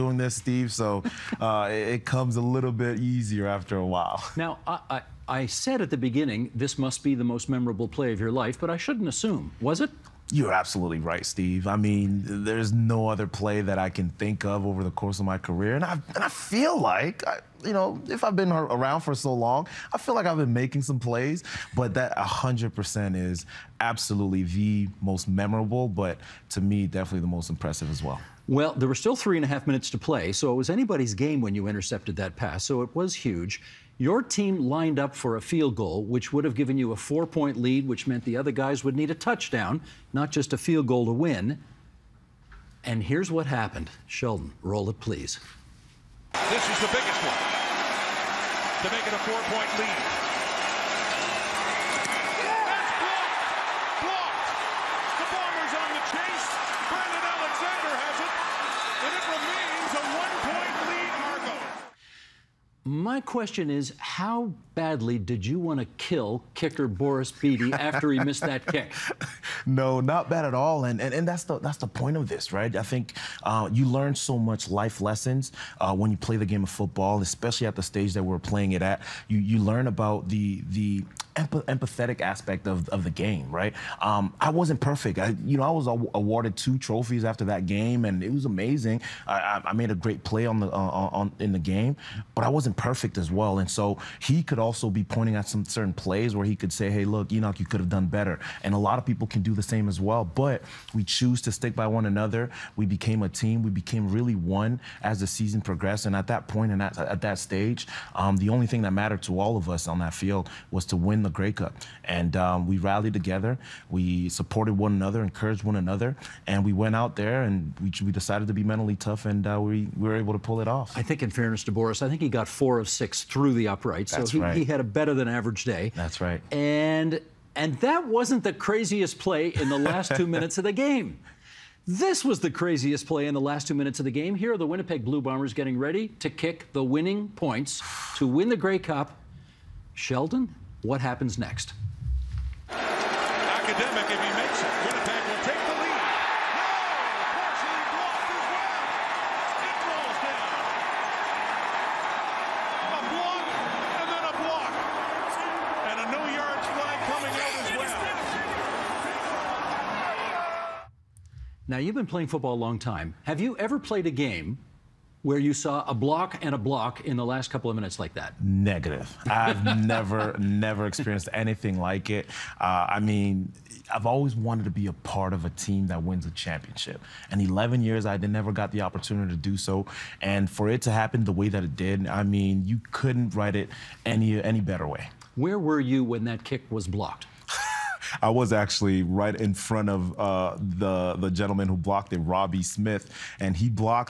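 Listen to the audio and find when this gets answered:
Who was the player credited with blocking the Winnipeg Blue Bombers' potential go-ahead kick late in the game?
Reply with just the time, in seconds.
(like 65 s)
192 s.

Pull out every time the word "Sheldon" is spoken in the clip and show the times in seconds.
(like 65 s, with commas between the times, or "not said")
44 s, 139 s.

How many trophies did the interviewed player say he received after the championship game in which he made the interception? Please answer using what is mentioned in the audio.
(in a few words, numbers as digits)
2.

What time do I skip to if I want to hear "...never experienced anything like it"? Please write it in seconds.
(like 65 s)
170 s.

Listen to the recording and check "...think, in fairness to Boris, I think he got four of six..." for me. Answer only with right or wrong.
right.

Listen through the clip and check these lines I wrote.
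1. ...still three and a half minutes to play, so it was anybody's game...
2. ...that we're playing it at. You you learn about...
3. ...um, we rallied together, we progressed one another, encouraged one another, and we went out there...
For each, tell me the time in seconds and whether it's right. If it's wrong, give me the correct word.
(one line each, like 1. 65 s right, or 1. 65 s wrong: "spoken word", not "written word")
1. 28 s right
2. 78 s right
3. 112 s wrong: "supported", not "progressed".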